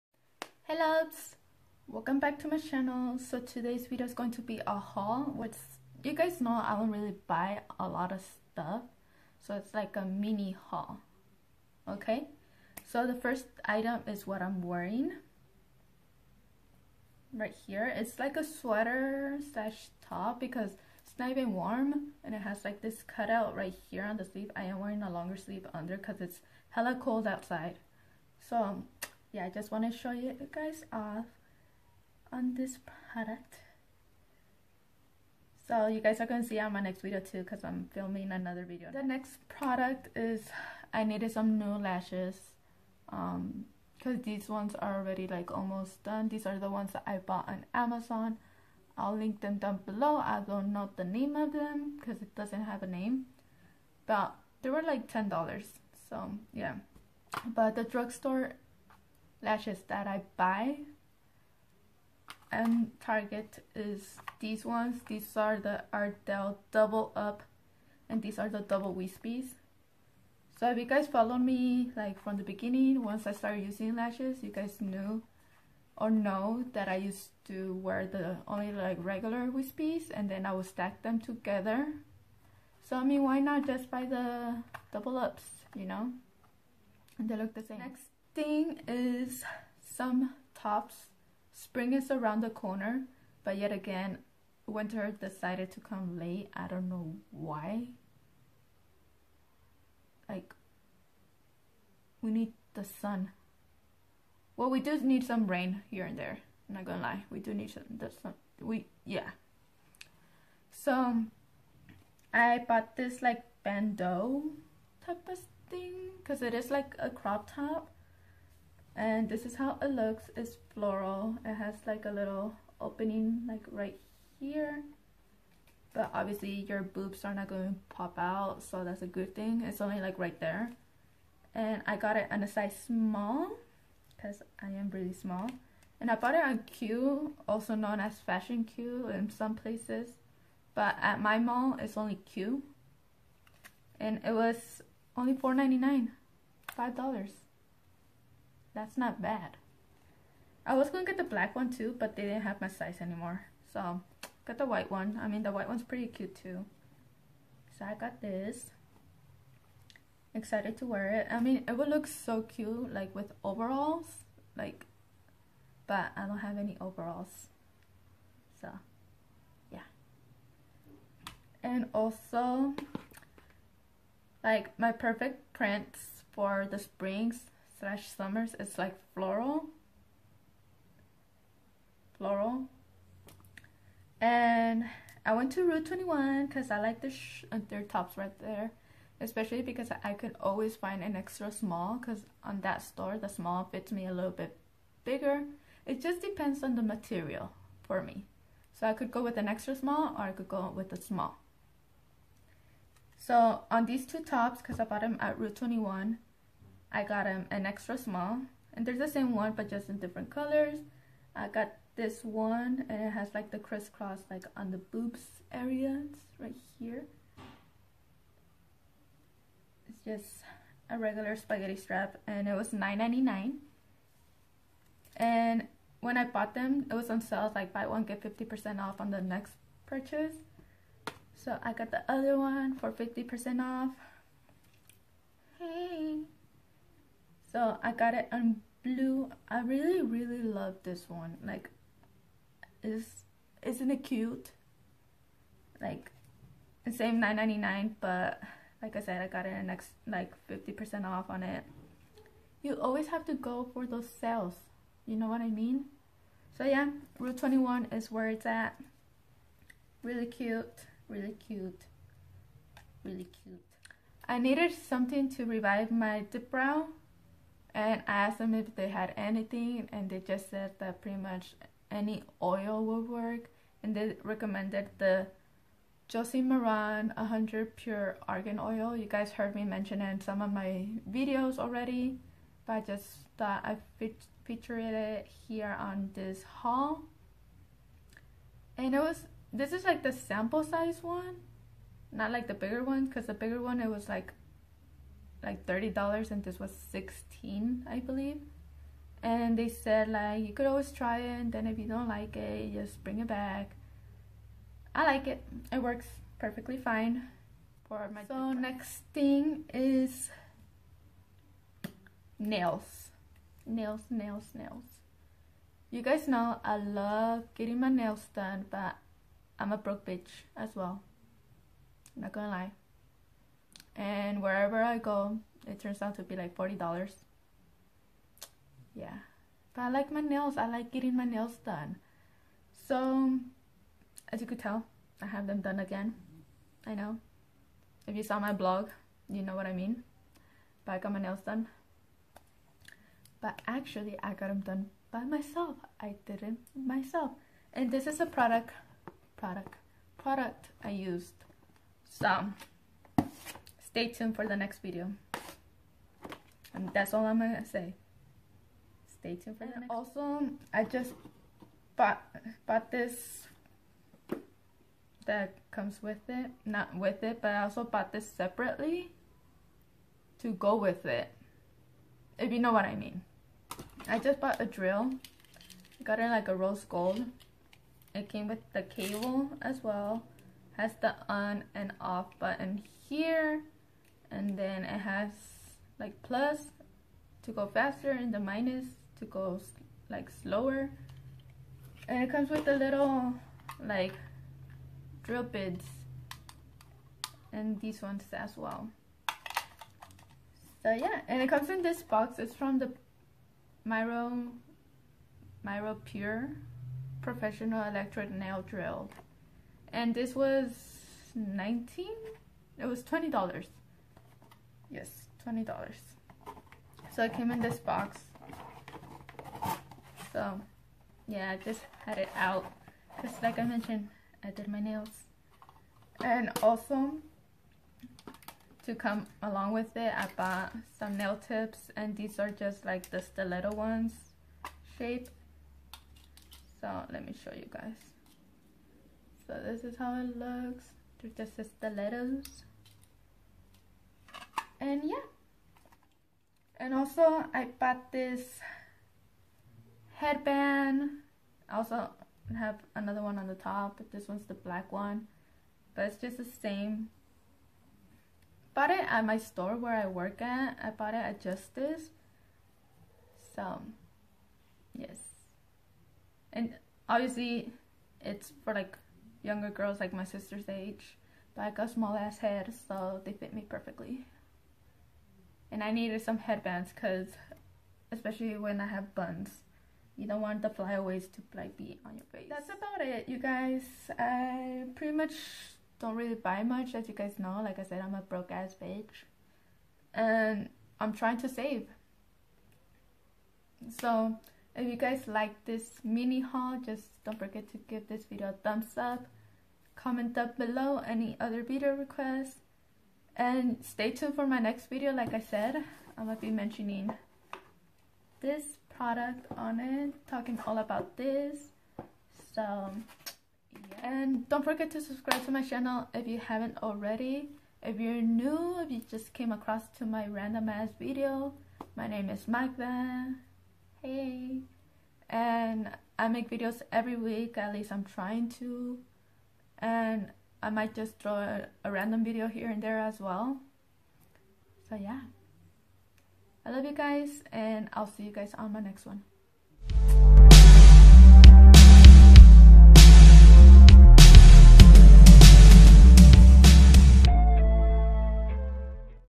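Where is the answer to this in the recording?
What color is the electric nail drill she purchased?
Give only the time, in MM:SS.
06:16.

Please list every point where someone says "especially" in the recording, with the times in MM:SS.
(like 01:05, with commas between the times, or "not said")
03:09, 07:58.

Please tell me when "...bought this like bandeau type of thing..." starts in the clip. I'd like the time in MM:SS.
01:52.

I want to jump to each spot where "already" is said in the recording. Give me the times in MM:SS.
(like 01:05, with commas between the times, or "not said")
00:44, 04:41, 08:36.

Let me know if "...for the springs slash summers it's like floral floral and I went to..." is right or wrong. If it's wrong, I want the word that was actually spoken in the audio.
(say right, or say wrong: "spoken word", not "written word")
right.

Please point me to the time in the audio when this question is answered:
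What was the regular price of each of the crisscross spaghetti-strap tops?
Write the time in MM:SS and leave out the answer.
03:42.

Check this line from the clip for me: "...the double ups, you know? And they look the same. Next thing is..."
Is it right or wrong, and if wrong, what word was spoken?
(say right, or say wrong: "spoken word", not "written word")
right.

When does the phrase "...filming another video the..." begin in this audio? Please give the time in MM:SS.
00:37.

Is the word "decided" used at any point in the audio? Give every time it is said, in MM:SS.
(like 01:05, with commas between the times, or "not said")
01:35.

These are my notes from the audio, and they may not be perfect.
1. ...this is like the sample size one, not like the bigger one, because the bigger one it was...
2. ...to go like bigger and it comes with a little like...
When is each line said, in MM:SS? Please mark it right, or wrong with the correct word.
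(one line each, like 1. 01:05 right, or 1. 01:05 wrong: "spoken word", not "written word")
1. 04:49 right
2. 06:29 wrong: "slower", not "bigger".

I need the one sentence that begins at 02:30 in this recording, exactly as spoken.
I was going to get the black one too, but they didn't have my size anymore.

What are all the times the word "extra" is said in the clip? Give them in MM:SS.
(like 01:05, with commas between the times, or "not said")
03:11, 03:19, 03:27.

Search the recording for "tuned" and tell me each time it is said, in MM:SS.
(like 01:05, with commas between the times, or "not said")
05:54, 05:59, 08:24.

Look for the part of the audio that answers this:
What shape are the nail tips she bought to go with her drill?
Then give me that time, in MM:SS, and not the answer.
07:13.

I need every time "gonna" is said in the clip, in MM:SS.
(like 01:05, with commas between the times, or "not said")
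01:46, 05:22, 05:57, 08:26.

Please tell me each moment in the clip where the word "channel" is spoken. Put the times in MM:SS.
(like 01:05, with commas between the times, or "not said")
00:02, 08:35.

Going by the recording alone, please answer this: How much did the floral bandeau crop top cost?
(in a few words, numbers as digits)
$4.99.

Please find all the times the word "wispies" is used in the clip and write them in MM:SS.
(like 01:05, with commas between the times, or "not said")
01:08, 01:19.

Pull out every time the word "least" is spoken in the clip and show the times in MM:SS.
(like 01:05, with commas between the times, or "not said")
08:47.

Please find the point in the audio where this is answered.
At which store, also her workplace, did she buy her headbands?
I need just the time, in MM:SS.
07:41.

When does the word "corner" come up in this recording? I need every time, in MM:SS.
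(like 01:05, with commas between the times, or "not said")
01:32.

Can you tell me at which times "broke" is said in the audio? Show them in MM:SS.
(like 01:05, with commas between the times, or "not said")
05:19, 08:08.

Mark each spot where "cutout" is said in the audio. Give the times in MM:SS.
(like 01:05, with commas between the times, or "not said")
00:23.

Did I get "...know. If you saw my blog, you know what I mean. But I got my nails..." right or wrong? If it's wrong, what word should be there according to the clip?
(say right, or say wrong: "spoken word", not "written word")
right.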